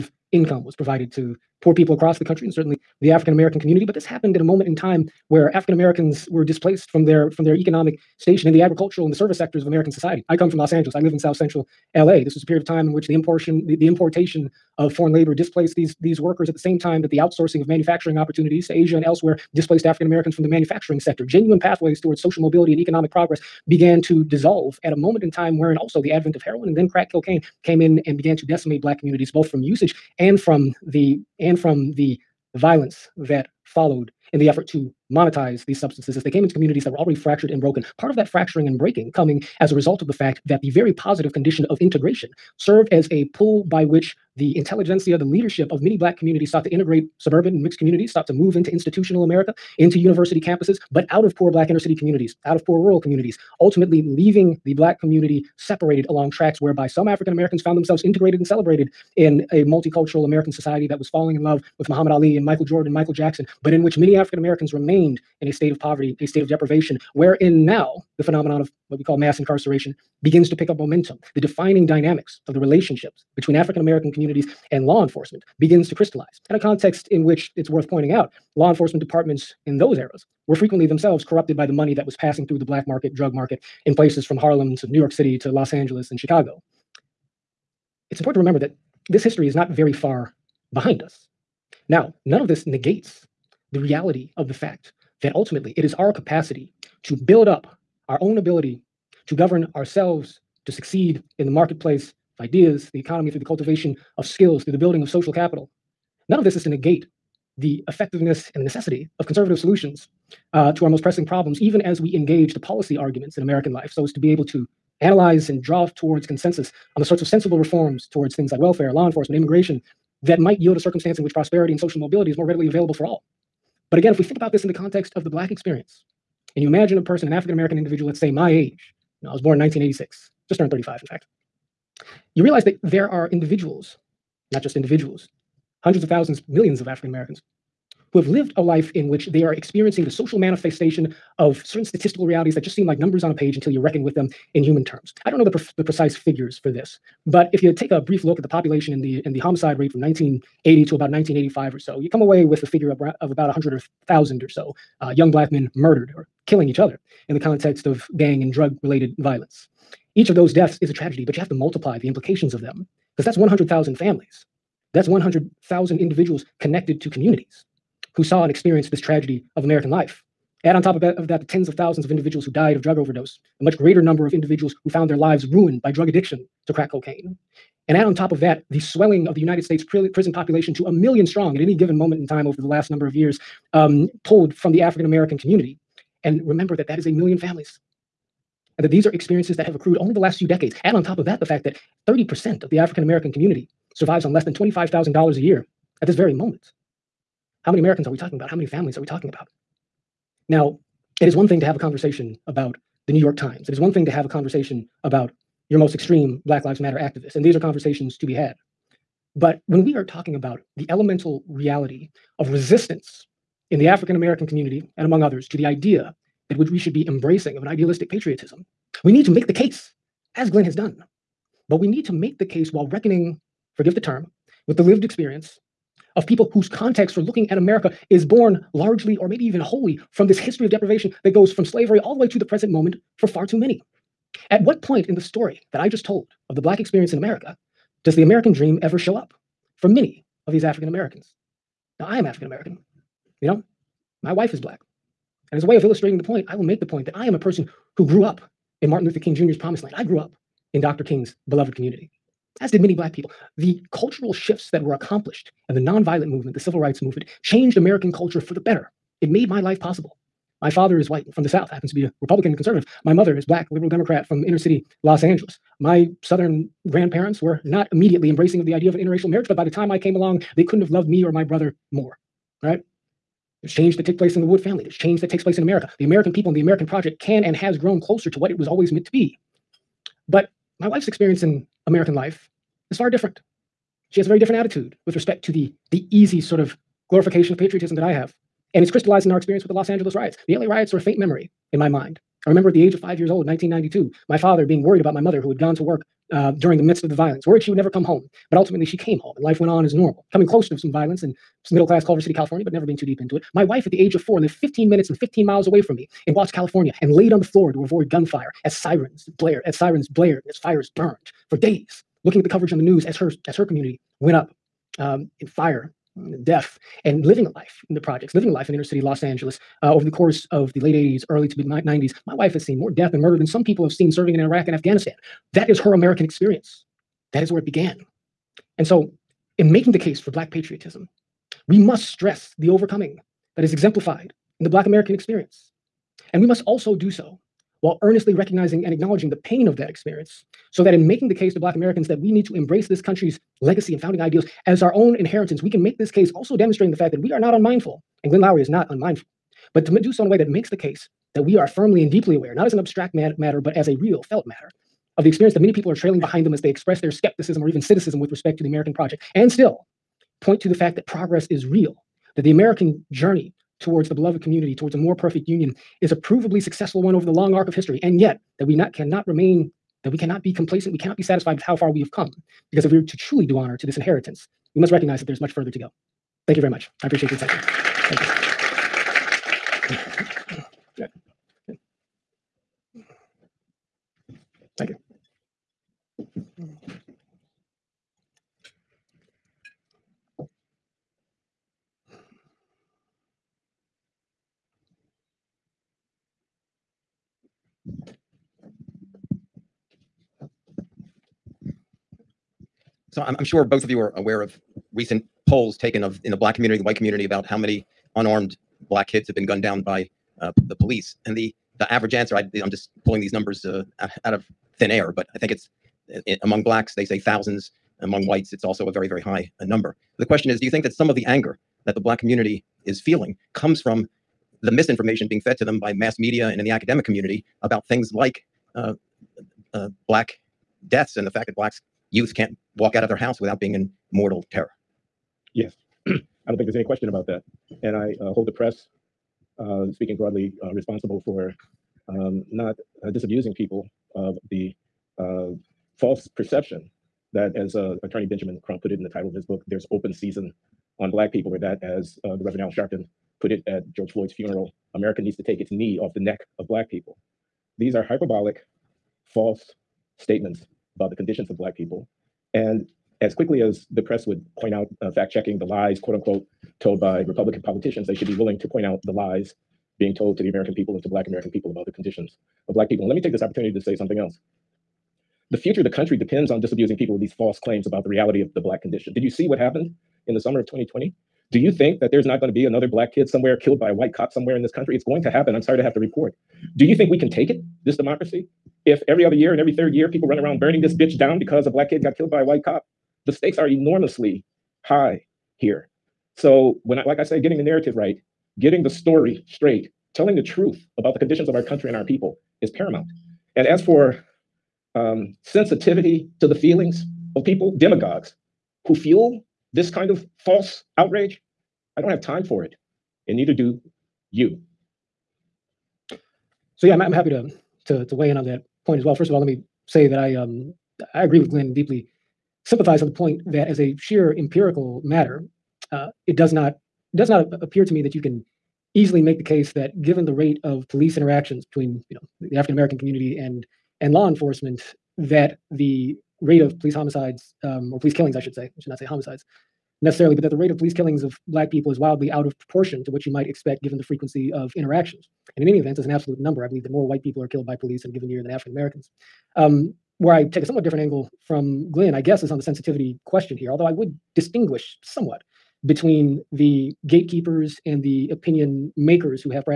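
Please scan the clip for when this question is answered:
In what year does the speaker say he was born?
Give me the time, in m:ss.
2:09.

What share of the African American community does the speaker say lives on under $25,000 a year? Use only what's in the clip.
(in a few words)
30%.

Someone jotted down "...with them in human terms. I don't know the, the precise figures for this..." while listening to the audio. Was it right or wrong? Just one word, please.
right.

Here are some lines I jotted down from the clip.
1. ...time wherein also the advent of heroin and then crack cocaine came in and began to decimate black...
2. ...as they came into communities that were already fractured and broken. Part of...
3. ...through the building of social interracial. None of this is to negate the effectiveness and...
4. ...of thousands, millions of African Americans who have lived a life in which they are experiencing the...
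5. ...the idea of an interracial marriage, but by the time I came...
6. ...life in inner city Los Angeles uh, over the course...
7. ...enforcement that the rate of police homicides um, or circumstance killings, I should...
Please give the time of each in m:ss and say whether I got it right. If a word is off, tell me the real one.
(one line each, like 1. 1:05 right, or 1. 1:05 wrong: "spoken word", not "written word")
1. 0:25 right
2. 0:36 right
3. 1:44 wrong: "capital", not "interracial"
4. 2:16 right
5. 4:28 right
6. 5:18 right
7. 8:54 wrong: "police", not "circumstance".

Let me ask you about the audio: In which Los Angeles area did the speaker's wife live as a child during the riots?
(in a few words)
Watts.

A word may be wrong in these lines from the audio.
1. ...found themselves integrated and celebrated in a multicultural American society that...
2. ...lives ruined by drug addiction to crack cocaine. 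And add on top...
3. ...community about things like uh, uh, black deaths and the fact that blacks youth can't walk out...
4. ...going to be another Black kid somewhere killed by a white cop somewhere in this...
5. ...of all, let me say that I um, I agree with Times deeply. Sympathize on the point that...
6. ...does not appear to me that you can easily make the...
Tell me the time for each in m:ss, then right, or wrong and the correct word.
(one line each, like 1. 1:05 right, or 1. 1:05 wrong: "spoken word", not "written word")
1. 0:57 right
2. 2:55 right
3. 7:07 right
4. 8:02 right
5. 8:39 wrong: "Glenn", not "Times"
6. 8:47 right.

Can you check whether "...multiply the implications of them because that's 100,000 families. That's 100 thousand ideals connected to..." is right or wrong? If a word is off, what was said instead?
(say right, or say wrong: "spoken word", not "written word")
wrong: "individuals", not "ideals".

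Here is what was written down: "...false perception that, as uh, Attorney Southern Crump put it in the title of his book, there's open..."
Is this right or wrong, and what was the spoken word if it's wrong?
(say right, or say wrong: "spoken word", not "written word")
wrong: "Benjamin", not "Southern".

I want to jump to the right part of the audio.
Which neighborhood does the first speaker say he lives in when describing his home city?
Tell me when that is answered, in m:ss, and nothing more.
0:11.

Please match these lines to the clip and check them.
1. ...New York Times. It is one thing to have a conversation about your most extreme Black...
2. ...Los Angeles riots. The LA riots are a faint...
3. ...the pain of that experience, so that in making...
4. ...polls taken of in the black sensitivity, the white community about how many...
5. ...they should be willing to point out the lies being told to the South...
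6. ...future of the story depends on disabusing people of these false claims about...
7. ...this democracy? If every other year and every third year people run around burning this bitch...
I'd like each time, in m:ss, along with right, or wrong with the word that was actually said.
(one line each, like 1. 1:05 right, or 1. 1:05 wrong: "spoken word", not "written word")
1. 3:23 right
2. 4:49 right
3. 5:39 right
4. 6:45 wrong: "community", not "sensitivity"
5. 7:48 wrong: "American", not "South"
6. 7:55 wrong: "country", not "story"
7. 8:07 right.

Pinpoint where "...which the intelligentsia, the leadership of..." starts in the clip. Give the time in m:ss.
0:43.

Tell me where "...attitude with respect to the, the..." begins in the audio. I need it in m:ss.
4:44.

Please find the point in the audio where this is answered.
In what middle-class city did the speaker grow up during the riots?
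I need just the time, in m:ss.
5:02.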